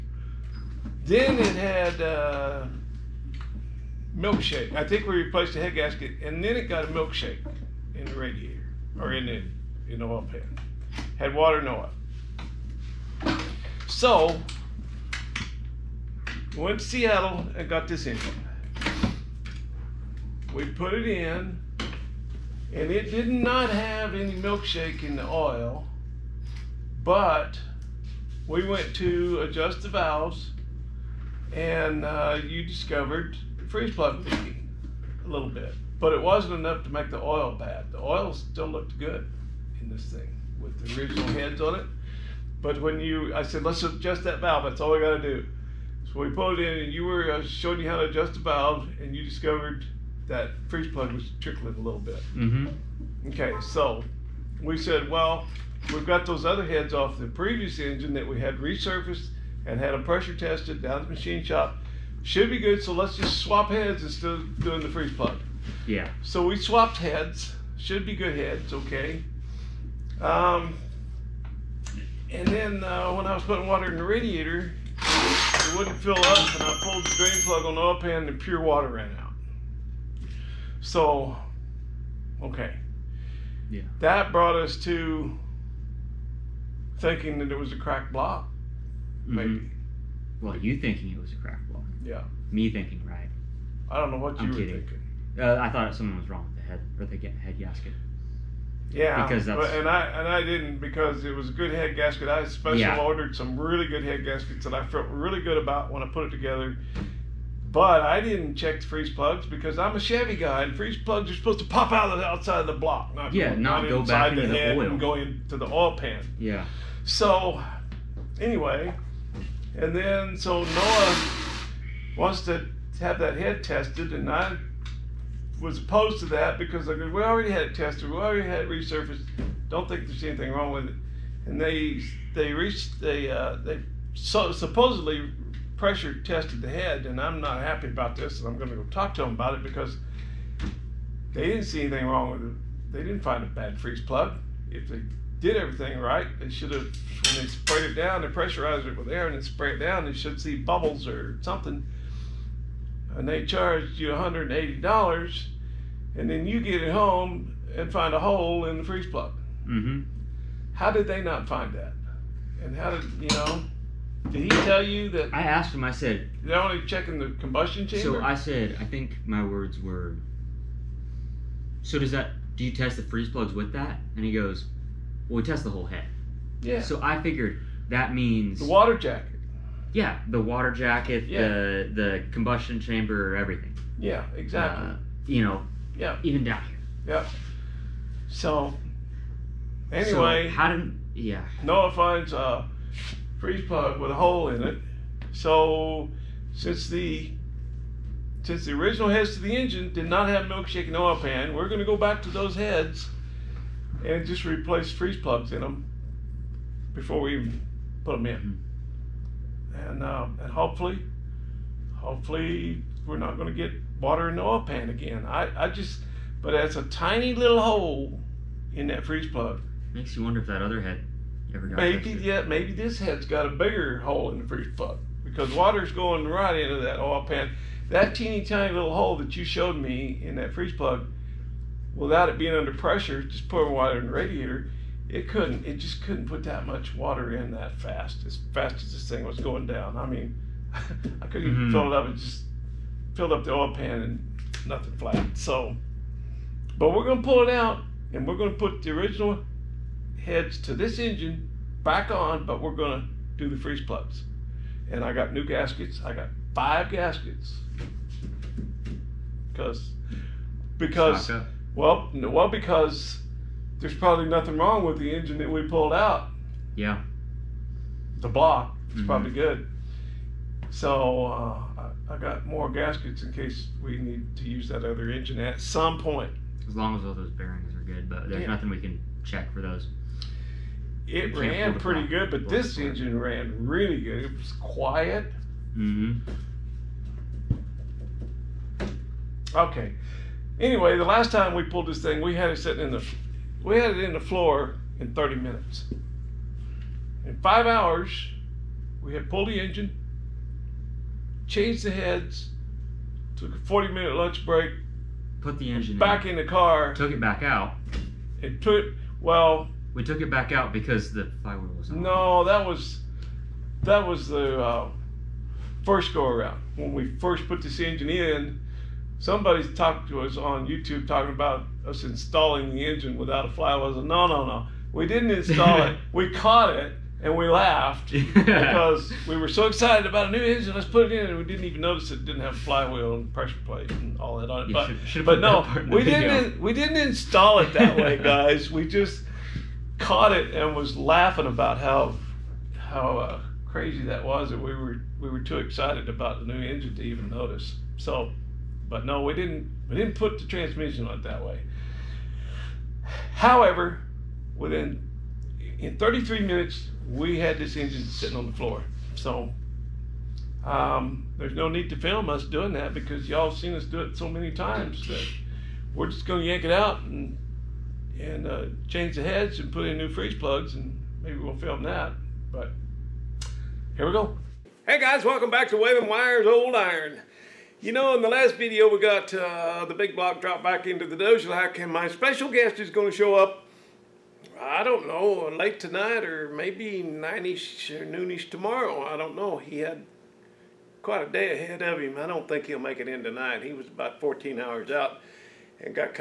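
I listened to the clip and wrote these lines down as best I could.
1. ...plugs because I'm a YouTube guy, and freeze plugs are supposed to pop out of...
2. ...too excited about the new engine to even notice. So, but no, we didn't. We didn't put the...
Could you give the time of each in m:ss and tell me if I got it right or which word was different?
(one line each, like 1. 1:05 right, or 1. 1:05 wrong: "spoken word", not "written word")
1. 1:49 wrong: "Chevy", not "YouTube"
2. 5:45 right.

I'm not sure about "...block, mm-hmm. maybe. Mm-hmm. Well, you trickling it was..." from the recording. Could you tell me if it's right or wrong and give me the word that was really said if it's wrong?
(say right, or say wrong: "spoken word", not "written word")
wrong: "thinking", not "trickling".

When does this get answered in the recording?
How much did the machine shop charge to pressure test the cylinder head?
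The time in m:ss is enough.
2:34.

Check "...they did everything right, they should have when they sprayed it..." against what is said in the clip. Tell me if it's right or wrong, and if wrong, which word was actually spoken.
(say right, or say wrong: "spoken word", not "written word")
right.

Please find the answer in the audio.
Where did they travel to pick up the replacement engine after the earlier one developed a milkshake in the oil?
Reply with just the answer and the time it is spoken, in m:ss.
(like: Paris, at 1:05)
Seattle, at 0:16.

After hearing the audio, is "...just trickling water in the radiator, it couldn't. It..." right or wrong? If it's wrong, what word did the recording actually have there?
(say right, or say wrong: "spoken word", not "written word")
wrong: "pouring", not "trickling".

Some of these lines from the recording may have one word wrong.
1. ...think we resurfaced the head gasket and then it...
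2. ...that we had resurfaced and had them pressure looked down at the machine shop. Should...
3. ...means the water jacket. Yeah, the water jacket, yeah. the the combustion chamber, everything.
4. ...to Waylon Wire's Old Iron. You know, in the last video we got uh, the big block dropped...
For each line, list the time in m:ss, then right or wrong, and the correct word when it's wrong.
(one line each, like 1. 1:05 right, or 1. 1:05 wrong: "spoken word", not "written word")
1. 0:04 wrong: "replaced", not "resurfaced"
2. 0:58 wrong: "tested", not "looked"
3. 2:58 right
4. 6:15 right.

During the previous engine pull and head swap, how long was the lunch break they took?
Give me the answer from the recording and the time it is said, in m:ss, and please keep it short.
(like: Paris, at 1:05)
40 minutes, at 5:03.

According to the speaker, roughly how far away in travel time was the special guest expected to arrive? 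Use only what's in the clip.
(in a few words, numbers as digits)
14 hours.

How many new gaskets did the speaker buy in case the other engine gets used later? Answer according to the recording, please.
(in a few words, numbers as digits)
5.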